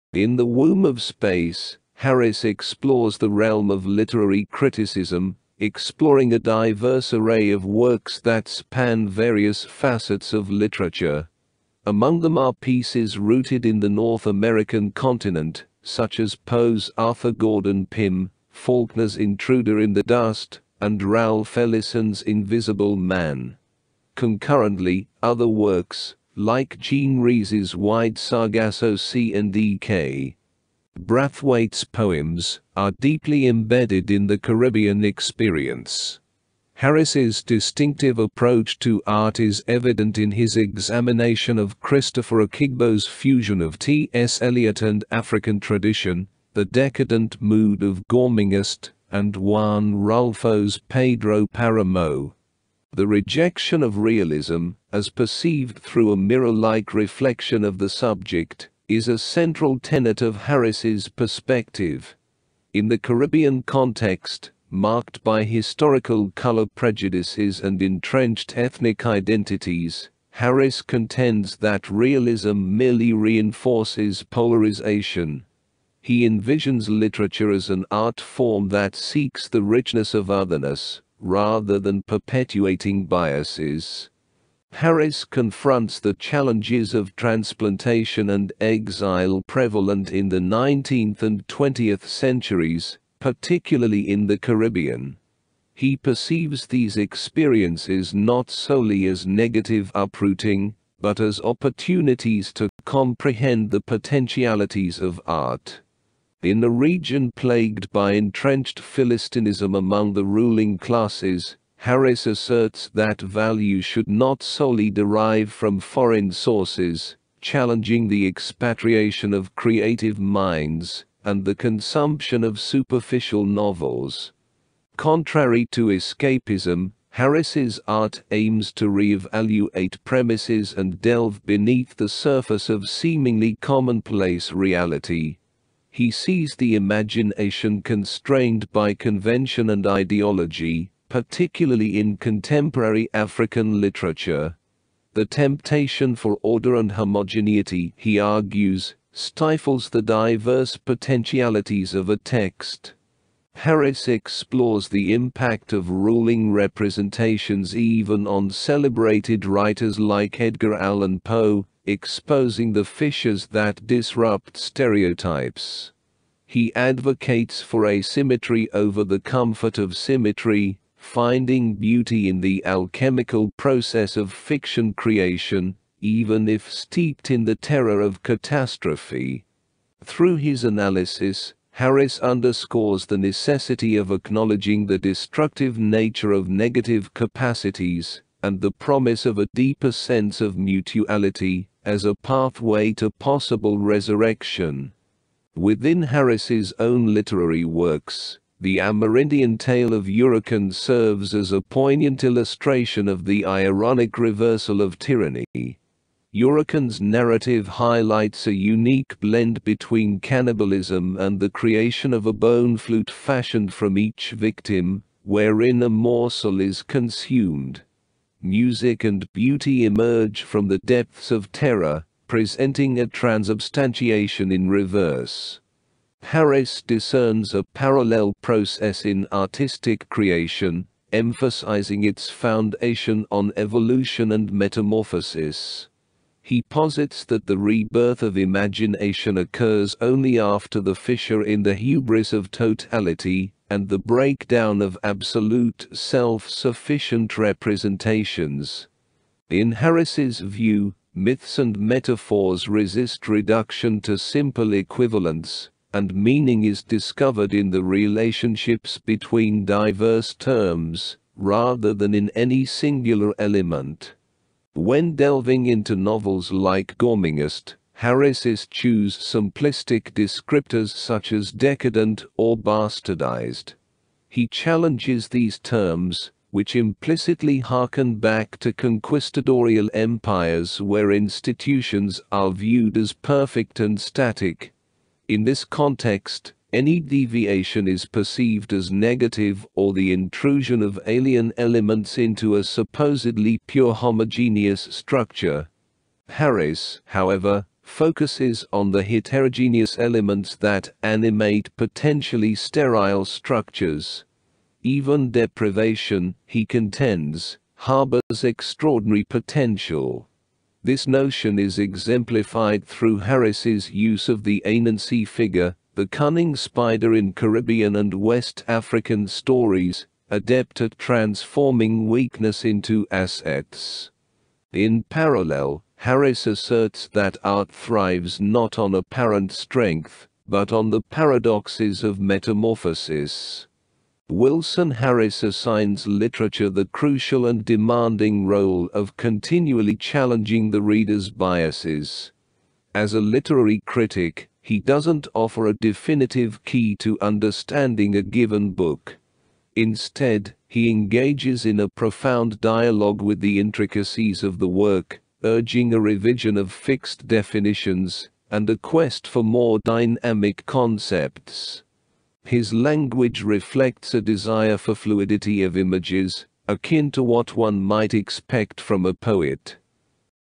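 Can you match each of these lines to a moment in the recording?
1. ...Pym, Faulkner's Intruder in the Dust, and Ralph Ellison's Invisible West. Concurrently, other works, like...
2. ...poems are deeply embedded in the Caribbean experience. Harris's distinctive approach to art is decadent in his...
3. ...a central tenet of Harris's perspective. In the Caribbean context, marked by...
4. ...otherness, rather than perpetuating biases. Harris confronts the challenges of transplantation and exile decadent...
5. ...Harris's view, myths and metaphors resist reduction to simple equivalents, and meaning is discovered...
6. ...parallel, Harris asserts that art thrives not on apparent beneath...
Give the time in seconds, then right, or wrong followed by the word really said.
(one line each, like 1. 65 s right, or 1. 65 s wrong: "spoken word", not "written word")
1. 17 s wrong: "Man", not "West"
2. 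31 s wrong: "evident", not "decadent"
3. 59 s right
4. 80 s wrong: "prevalent", not "decadent"
5. 249 s right
6. 325 s wrong: "strength", not "beneath".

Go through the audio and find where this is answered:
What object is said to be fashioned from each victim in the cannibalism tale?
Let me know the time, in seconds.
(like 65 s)
212 s.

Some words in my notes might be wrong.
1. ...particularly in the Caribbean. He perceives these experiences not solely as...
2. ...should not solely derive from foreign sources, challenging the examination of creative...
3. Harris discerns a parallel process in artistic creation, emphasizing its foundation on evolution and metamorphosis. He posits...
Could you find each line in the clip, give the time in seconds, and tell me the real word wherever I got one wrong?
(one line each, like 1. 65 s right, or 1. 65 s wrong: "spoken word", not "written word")
1. 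93 s right
2. 113 s wrong: "expatriation", not "examination"
3. 226 s right.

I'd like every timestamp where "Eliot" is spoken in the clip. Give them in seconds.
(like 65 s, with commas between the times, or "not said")
44 s.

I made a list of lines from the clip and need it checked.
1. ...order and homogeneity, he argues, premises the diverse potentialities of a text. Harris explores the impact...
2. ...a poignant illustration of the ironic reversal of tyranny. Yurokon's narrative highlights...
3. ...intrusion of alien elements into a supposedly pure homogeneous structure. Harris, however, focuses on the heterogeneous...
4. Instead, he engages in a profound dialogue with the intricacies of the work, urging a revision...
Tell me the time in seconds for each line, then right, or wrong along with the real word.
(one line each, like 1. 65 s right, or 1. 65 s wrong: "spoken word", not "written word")
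1. 146 s wrong: "stifles", not "premises"
2. 201 s right
3. 290 s right
4. 349 s right.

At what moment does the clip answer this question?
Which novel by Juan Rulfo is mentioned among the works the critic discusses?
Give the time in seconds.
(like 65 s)
50 s.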